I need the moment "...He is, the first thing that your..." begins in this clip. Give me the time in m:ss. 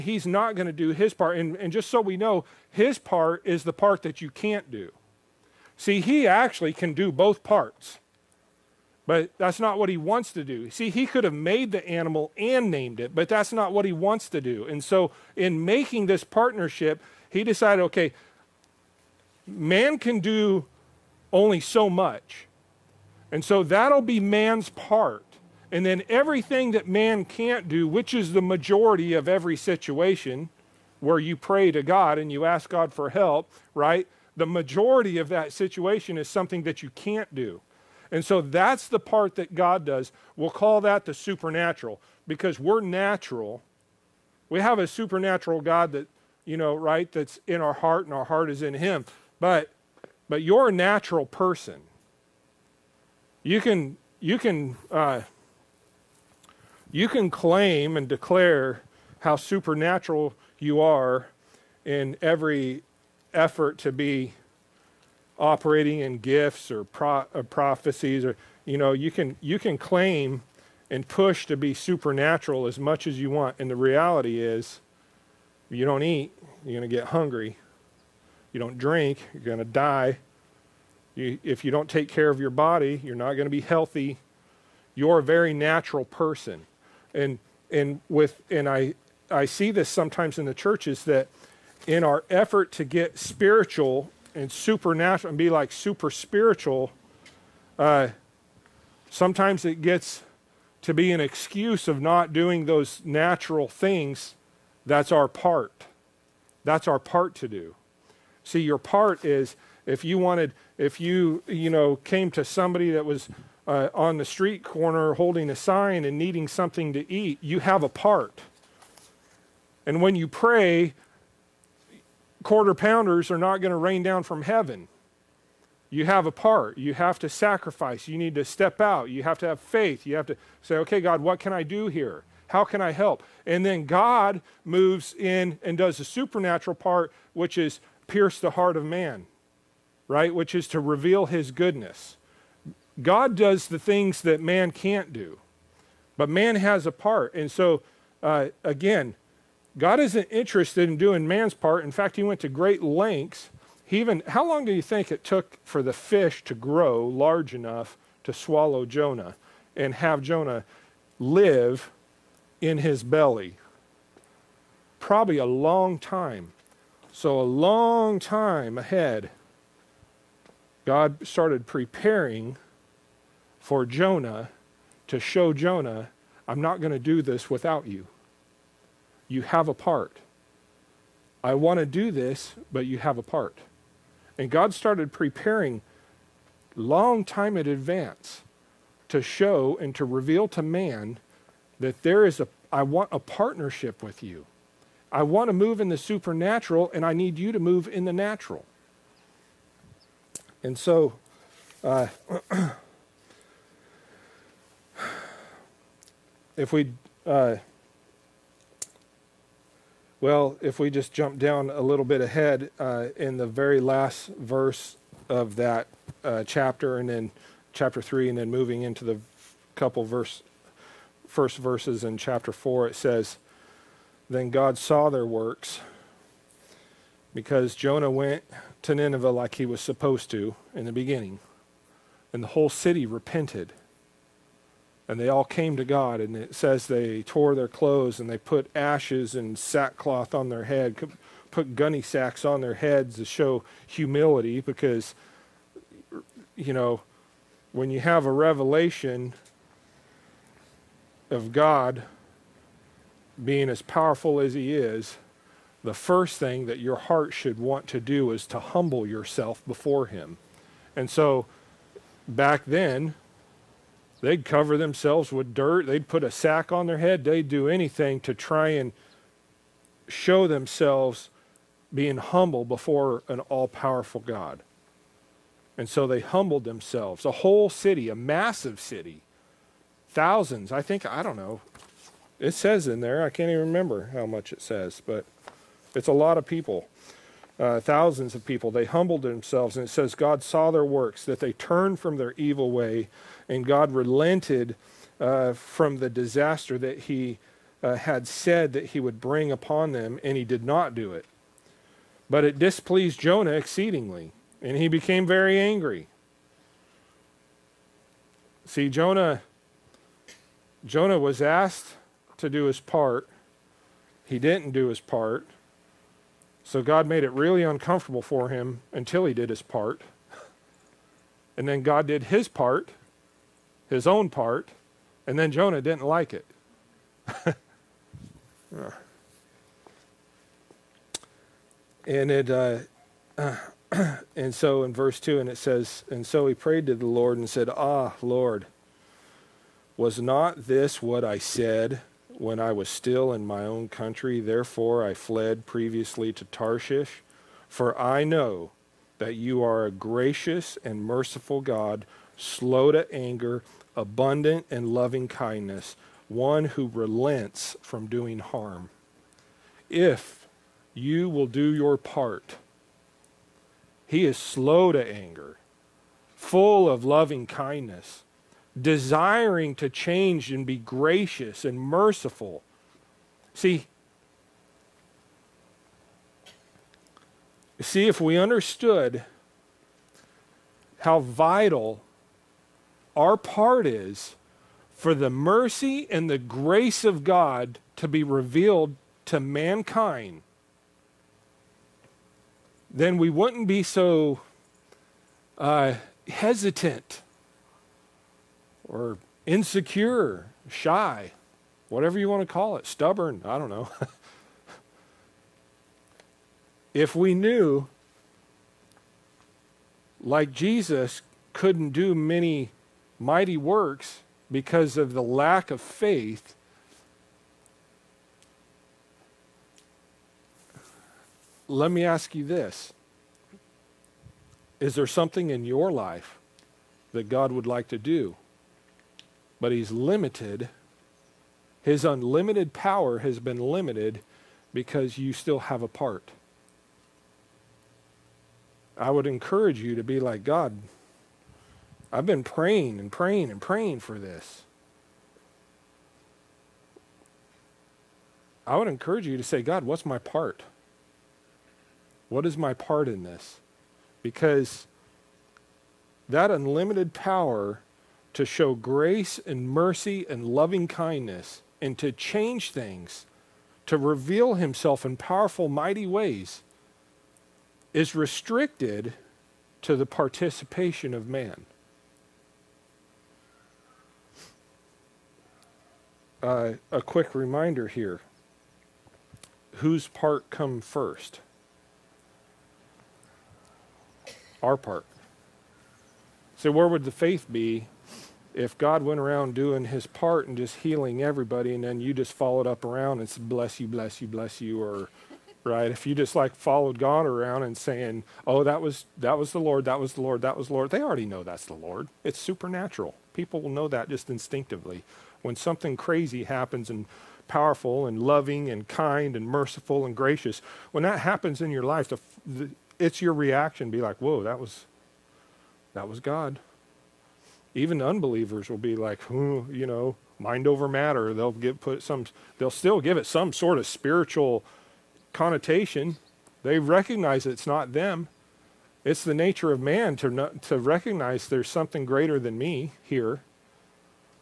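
4:14.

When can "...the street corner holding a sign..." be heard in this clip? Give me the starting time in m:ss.
1:54.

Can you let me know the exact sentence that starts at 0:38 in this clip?
And so that's the part that God does.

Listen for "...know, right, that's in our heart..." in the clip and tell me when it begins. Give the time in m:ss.
0:46.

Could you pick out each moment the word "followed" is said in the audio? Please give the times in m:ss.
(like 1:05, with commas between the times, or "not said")
8:12, 8:16.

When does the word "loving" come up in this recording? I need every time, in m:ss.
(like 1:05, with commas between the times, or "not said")
5:54, 6:07, 7:40, 8:28.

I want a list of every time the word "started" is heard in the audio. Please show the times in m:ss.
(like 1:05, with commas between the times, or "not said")
2:51, 3:04.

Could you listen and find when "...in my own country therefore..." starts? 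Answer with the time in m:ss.
5:43.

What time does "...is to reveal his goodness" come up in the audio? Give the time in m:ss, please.
2:20.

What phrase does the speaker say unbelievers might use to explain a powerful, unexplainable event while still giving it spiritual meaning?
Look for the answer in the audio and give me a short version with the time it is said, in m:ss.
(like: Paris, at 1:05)
Mind over matter, at 8:40.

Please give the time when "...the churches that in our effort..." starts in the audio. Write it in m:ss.
1:30.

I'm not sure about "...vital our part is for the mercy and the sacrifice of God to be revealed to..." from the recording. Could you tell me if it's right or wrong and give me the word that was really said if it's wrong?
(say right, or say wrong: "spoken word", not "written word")
wrong: "grace", not "sacrifice".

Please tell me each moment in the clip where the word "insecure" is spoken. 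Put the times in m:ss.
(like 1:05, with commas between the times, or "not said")
6:39.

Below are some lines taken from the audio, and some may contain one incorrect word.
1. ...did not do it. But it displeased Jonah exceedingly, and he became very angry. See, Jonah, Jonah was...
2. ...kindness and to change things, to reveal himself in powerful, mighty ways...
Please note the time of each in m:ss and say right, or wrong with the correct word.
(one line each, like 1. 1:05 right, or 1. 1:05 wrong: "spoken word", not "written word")
1. 5:00 right
2. 7:40 right.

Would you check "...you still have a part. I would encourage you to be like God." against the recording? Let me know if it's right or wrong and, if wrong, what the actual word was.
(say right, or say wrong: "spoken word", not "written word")
right.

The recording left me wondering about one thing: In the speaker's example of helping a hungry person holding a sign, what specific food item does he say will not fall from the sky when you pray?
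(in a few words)
Quarter pounders.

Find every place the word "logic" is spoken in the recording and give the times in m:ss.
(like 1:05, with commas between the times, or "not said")
not said.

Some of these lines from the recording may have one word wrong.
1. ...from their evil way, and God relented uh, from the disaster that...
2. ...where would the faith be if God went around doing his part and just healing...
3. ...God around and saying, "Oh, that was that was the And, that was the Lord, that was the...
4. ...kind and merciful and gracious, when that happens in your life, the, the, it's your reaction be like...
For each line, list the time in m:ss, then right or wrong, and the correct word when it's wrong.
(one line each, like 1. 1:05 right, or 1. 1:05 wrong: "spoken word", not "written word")
1. 4:51 right
2. 8:06 right
3. 8:16 wrong: "Lord", not "And"
4. 8:28 right.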